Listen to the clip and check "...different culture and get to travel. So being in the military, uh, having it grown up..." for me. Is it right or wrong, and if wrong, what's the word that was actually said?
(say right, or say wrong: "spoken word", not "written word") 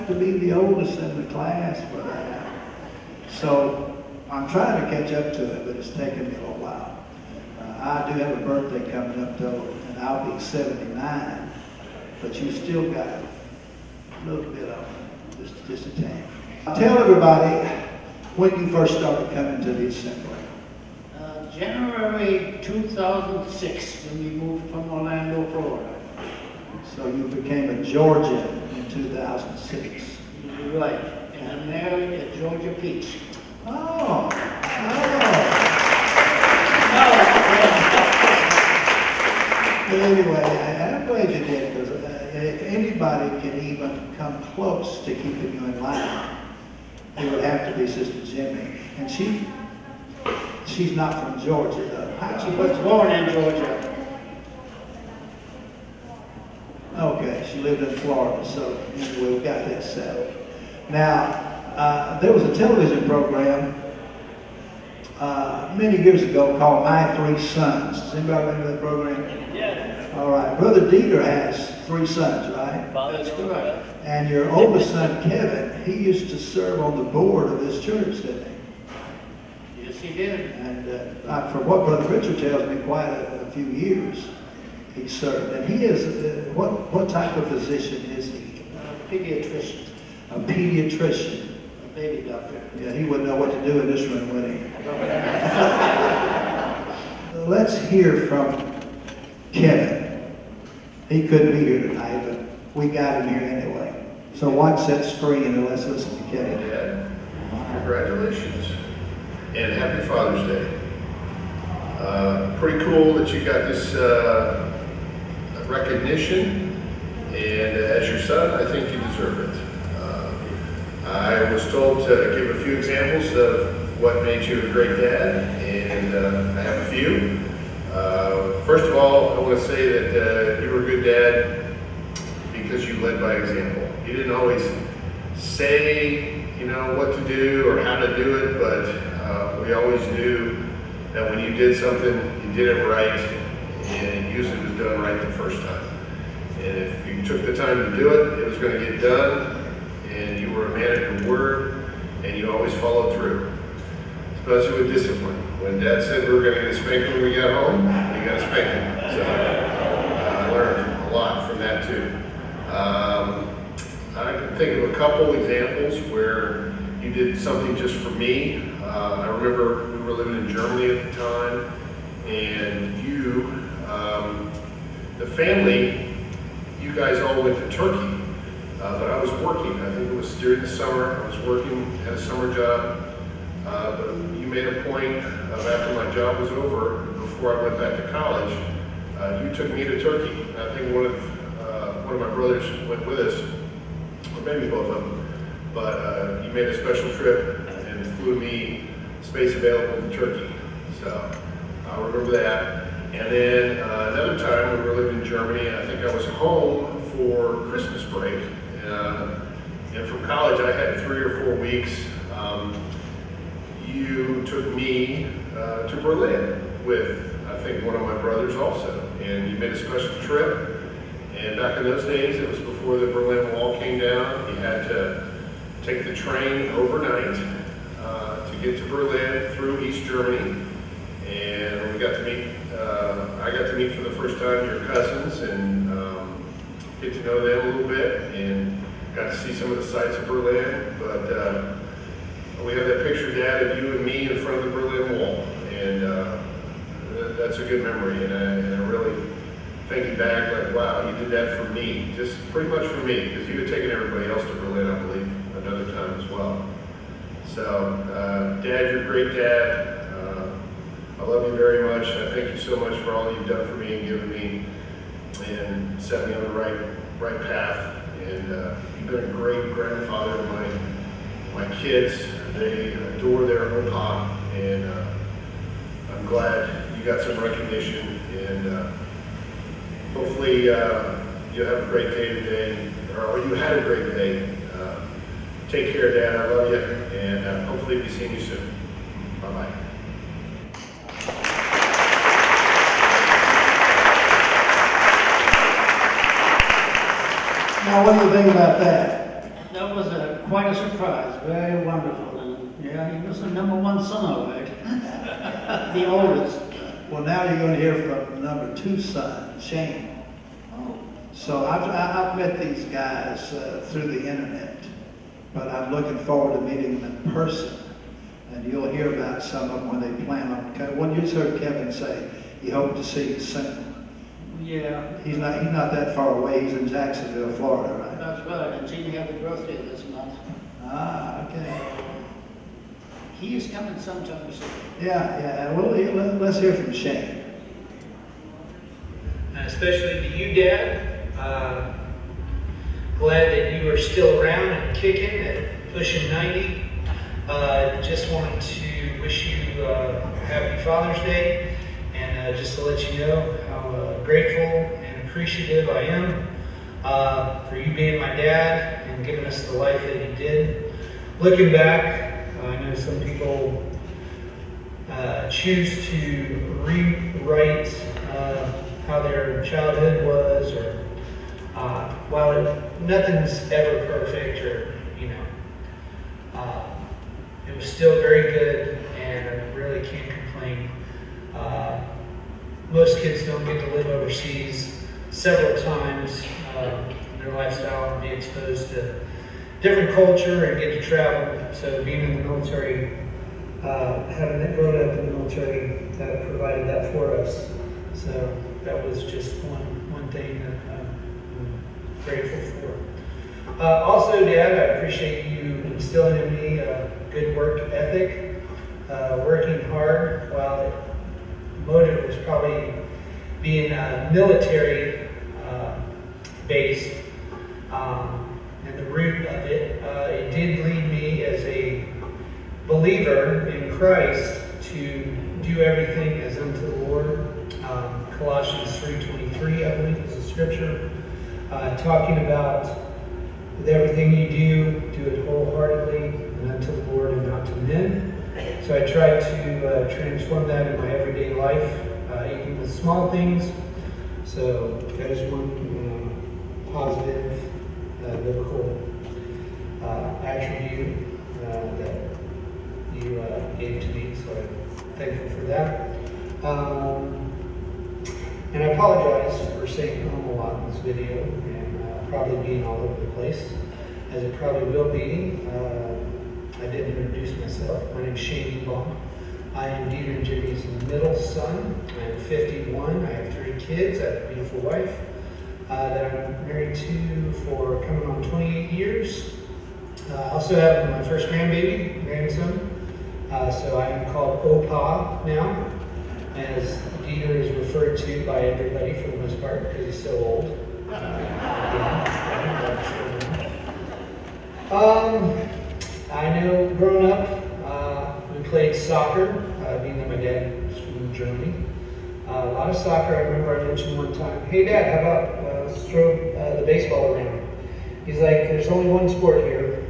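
right.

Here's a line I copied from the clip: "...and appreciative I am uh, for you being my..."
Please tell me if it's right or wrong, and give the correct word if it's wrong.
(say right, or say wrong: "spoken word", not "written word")
right.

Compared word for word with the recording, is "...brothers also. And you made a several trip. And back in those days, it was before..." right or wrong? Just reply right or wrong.
wrong.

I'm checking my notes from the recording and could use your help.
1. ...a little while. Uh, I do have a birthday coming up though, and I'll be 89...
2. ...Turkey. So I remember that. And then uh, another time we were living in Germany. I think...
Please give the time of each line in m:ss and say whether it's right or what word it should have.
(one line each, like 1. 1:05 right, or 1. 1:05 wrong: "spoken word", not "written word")
1. 0:06 wrong: "79", not "89"
2. 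3:20 right.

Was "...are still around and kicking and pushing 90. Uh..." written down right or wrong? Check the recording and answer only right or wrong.
right.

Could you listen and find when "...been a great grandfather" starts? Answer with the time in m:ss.
4:29.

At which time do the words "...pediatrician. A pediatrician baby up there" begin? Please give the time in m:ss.
1:29.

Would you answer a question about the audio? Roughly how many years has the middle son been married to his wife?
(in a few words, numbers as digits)
28.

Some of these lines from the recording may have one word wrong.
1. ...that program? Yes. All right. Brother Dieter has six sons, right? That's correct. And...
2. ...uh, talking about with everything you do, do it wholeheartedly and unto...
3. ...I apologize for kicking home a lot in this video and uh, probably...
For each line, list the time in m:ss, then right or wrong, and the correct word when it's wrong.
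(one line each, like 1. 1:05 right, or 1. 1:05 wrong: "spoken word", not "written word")
1. 1:08 wrong: "three", not "six"
2. 7:11 right
3. 7:38 wrong: "saying", not "kicking".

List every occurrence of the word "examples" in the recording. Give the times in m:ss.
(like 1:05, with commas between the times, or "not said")
2:02, 2:13, 2:45.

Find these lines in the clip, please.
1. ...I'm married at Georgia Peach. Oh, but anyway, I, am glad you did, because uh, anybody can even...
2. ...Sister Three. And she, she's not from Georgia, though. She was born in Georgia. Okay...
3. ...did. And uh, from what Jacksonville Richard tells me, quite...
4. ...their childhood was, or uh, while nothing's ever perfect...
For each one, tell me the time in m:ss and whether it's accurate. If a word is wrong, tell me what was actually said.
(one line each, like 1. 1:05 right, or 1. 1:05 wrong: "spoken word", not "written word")
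1. 0:31 right
2. 0:47 wrong: "Jimmy", not "Three"
3. 1:20 wrong: "Brother", not "Jacksonville"
4. 6:09 right.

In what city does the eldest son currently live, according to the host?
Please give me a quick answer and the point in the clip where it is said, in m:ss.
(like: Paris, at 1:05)
Jacksonville, Florida, at 5:26.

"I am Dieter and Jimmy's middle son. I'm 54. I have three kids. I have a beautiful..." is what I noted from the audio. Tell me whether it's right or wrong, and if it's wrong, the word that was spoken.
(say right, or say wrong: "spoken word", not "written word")
wrong: "51", not "54".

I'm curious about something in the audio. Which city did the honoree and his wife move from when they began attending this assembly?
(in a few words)
Orlando, Florida.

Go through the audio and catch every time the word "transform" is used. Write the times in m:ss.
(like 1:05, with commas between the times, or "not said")
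7:20.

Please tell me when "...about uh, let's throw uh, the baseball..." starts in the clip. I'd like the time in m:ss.
8:25.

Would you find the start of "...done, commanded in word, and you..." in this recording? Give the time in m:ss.
2:28.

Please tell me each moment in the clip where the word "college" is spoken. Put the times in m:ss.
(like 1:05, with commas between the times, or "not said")
3:08, 3:30.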